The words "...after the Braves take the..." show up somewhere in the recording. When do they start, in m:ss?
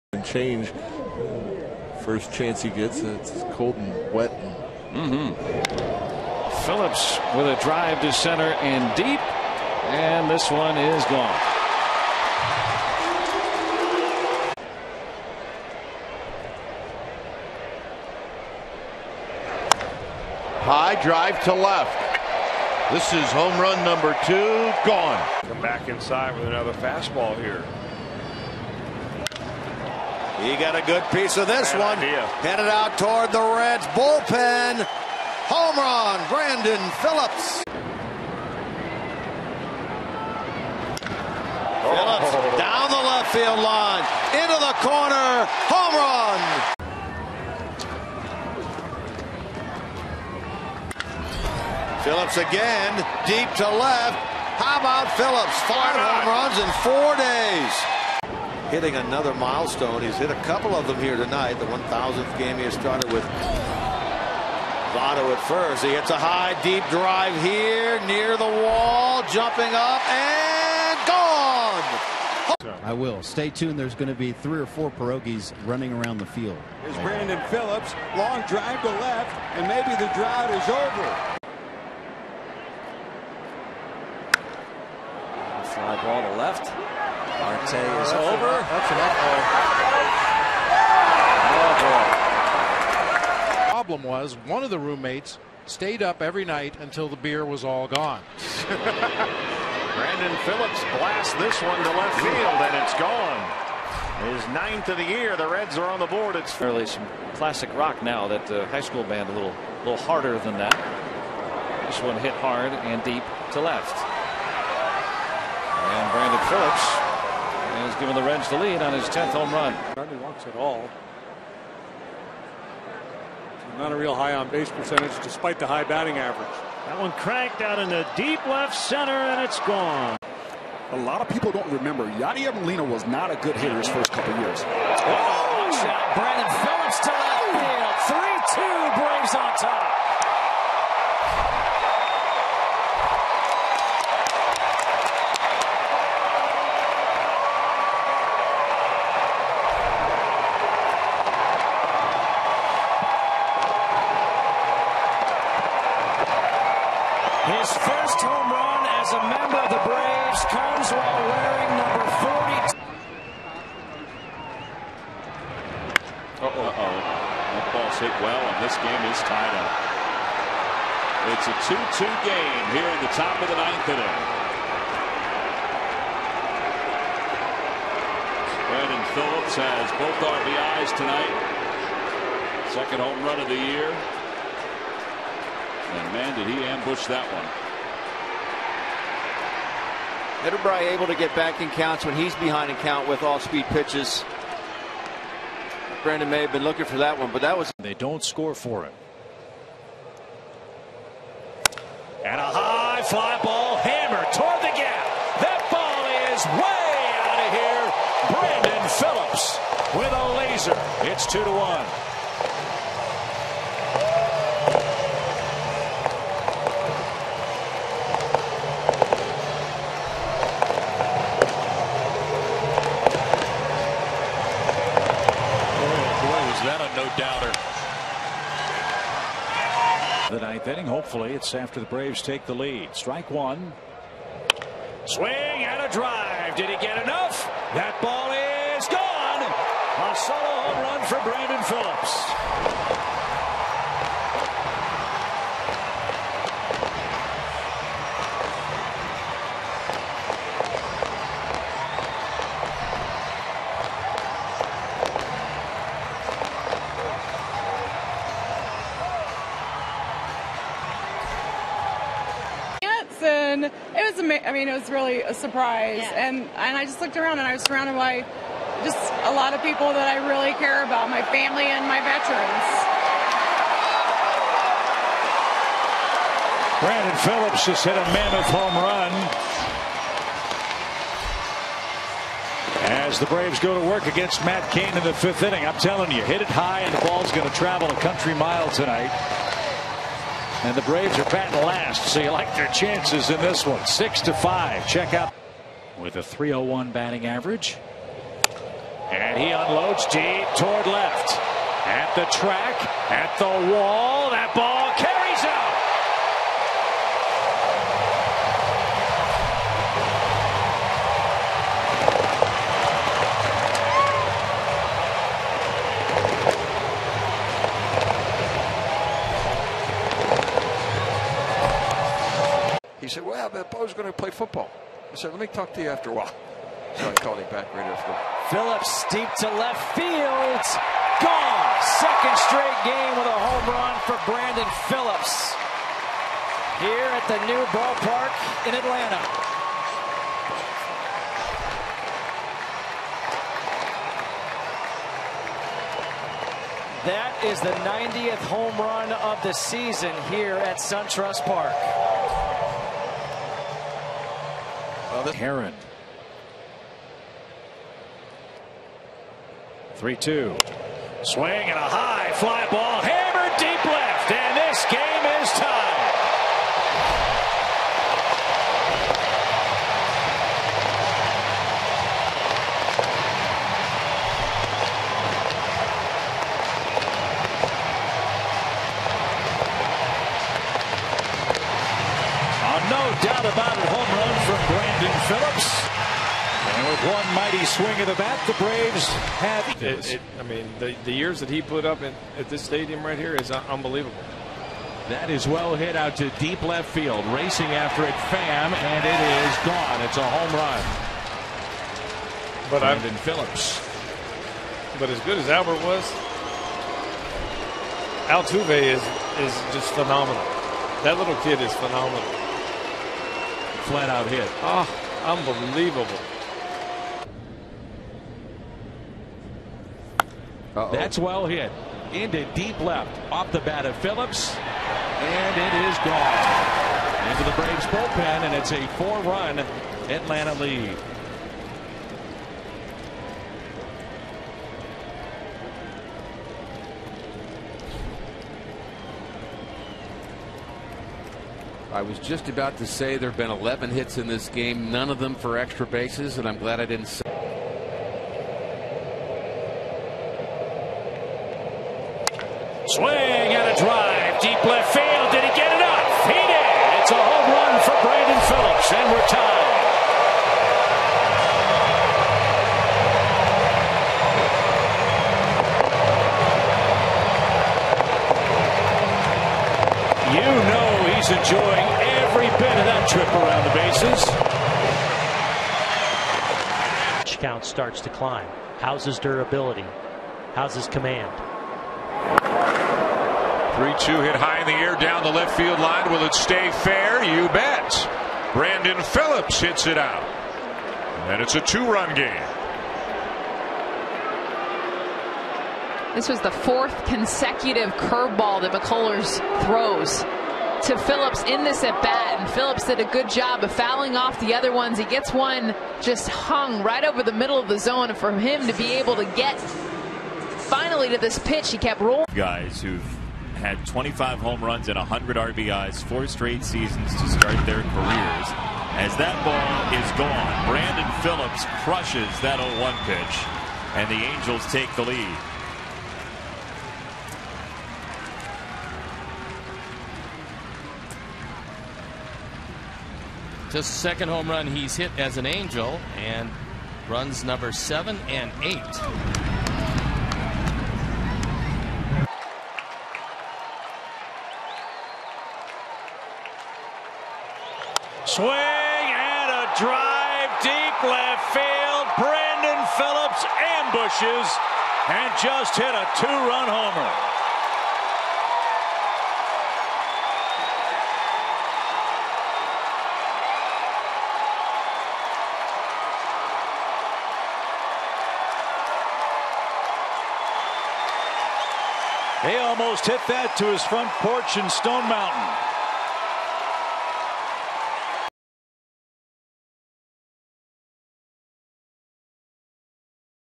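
3:51.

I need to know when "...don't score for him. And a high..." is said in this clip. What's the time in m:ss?
3:17.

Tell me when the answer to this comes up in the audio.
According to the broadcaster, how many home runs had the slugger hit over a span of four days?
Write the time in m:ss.
0:55.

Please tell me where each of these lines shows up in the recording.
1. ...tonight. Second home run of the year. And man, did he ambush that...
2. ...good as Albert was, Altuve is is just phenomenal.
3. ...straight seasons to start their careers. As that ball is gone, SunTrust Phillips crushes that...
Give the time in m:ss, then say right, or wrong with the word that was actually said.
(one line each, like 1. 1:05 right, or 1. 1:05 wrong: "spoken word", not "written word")
1. 3:00 right
2. 6:45 right
3. 8:36 wrong: "Brandon", not "SunTrust".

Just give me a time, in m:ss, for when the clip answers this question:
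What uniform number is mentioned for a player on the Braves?
2:41.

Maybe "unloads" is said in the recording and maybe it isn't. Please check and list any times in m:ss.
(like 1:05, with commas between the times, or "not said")
4:59.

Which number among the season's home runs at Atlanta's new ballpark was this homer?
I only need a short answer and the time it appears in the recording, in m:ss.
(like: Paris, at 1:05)
90, at 5:47.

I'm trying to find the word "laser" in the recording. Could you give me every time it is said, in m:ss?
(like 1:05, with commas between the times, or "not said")
3:30.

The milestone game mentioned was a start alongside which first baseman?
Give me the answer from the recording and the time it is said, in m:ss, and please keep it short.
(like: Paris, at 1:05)
Votto, at 1:04.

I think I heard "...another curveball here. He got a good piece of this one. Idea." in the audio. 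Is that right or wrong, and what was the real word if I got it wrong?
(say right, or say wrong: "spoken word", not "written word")
wrong: "fastball", not "curveball".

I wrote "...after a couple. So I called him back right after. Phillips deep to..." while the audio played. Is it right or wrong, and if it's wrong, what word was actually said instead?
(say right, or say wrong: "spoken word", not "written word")
wrong: "while", not "couple".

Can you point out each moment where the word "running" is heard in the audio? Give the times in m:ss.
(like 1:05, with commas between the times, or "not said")
1:15.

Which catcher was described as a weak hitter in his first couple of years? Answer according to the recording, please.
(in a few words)
Yadier Molina.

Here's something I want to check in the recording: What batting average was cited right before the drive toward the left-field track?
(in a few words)
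301.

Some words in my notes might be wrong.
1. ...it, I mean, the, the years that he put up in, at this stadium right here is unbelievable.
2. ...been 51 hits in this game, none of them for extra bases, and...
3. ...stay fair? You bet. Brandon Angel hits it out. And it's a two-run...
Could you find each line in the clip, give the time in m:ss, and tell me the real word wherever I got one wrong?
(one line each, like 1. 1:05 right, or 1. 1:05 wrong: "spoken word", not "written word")
1. 6:30 right
2. 7:23 wrong: "11", not "51"
3. 8:06 wrong: "Phillips", not "Angel".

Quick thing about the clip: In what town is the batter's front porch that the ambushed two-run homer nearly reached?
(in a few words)
Stone Mountain.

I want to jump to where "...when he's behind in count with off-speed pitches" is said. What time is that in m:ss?
3:12.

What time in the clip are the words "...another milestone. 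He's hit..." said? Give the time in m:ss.
0:58.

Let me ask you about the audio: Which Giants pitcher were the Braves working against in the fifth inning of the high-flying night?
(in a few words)
Matt Cain.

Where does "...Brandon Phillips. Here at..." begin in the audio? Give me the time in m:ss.
5:34.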